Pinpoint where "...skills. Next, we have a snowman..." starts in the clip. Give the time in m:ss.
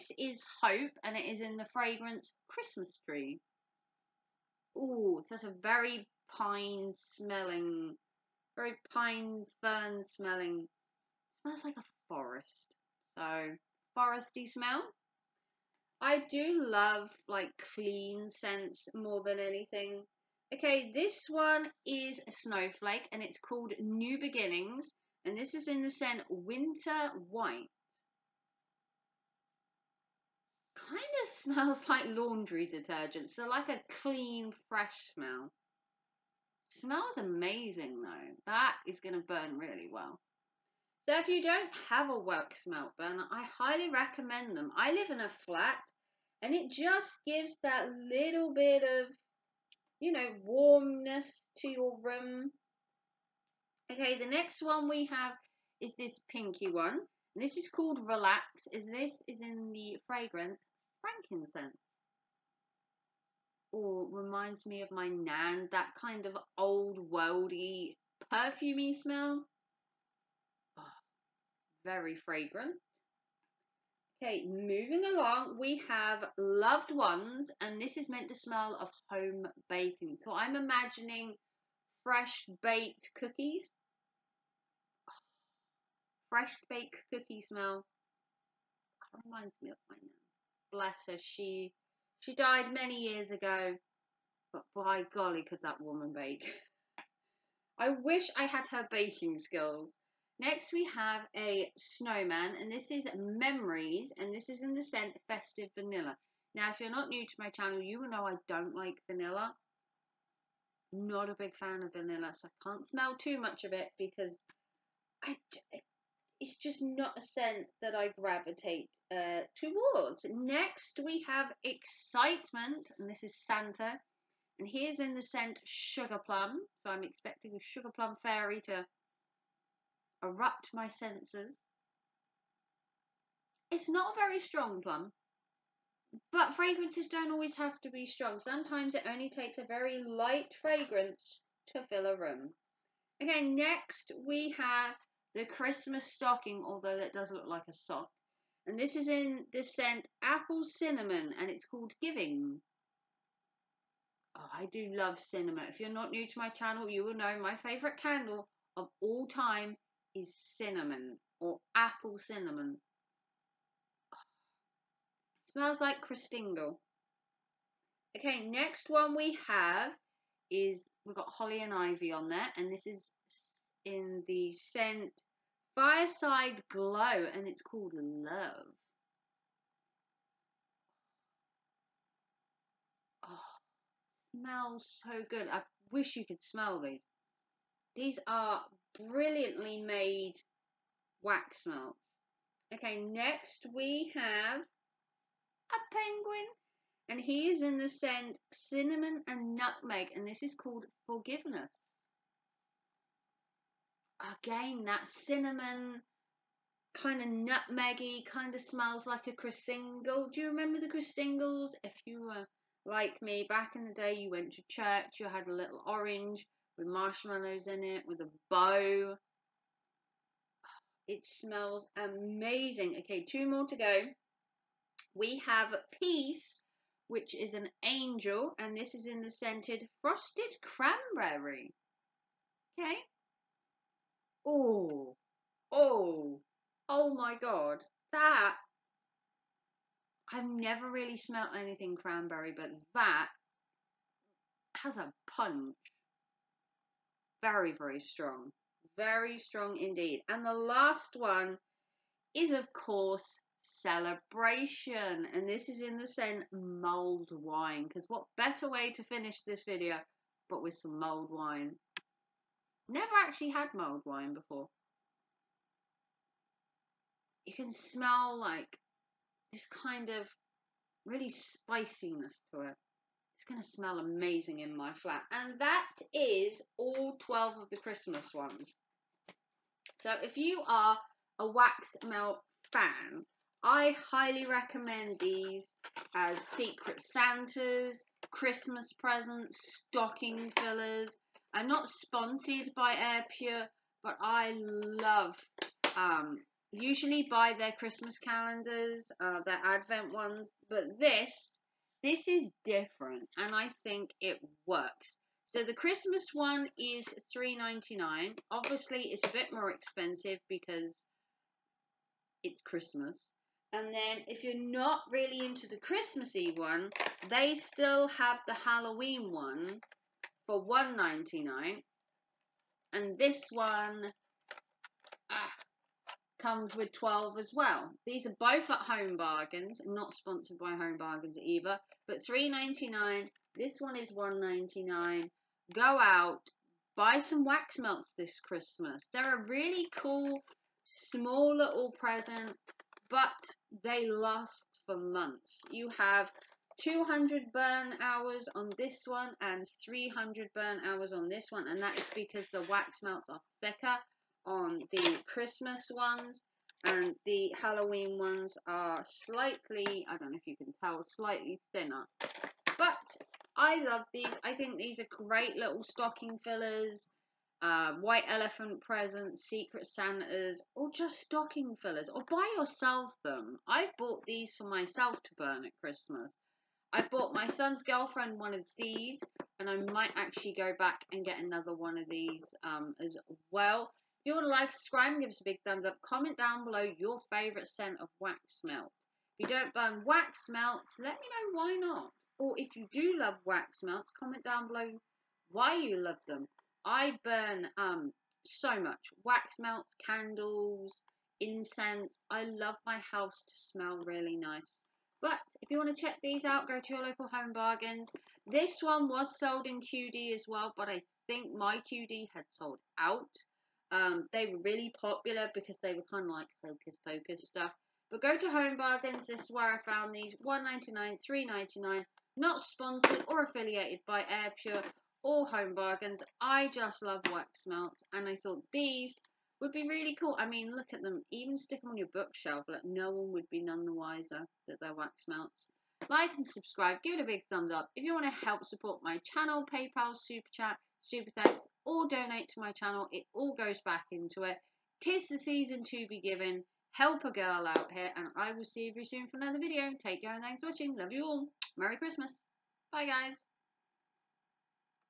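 1:39.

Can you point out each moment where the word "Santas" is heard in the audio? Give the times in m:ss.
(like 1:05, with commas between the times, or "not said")
2:03, 4:47, 6:09.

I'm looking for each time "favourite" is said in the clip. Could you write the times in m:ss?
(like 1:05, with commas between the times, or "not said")
2:37, 6:27.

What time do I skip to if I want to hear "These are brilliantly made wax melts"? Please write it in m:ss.
3:07.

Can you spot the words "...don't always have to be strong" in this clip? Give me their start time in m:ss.
2:17.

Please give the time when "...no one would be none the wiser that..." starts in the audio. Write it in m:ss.
7:12.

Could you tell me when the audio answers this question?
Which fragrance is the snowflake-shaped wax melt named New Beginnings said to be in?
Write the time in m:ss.
0:26.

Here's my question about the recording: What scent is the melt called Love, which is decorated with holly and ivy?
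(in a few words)
Fireside Glow.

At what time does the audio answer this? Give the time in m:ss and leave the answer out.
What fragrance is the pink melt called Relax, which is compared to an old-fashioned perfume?
1:01.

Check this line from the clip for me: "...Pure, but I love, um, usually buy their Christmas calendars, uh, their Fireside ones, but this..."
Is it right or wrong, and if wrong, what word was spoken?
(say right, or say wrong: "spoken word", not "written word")
wrong: "Advent", not "Fireside".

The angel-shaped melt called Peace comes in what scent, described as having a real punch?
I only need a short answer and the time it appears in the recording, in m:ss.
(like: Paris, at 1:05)
Frosted cranberry, at 3:50.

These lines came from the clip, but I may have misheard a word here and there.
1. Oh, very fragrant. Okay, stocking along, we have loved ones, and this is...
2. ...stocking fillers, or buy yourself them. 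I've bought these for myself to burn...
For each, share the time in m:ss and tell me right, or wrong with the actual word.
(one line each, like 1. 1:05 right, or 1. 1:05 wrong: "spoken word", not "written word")
1. 1:10 wrong: "moving", not "stocking"
2. 6:11 right.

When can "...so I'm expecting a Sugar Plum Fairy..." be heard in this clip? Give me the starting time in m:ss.
2:06.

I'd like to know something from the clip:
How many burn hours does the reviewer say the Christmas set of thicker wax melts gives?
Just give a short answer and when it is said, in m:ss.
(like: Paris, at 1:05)
300, at 5:49.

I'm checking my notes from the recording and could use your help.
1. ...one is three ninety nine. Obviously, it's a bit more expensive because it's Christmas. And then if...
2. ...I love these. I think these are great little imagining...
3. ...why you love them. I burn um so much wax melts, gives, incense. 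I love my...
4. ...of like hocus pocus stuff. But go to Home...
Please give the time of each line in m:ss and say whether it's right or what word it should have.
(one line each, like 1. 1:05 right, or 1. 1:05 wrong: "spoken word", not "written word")
1. 5:06 right
2. 6:03 wrong: "stocking", not "imagining"
3. 6:35 wrong: "candles", not "gives"
4. 6:56 right.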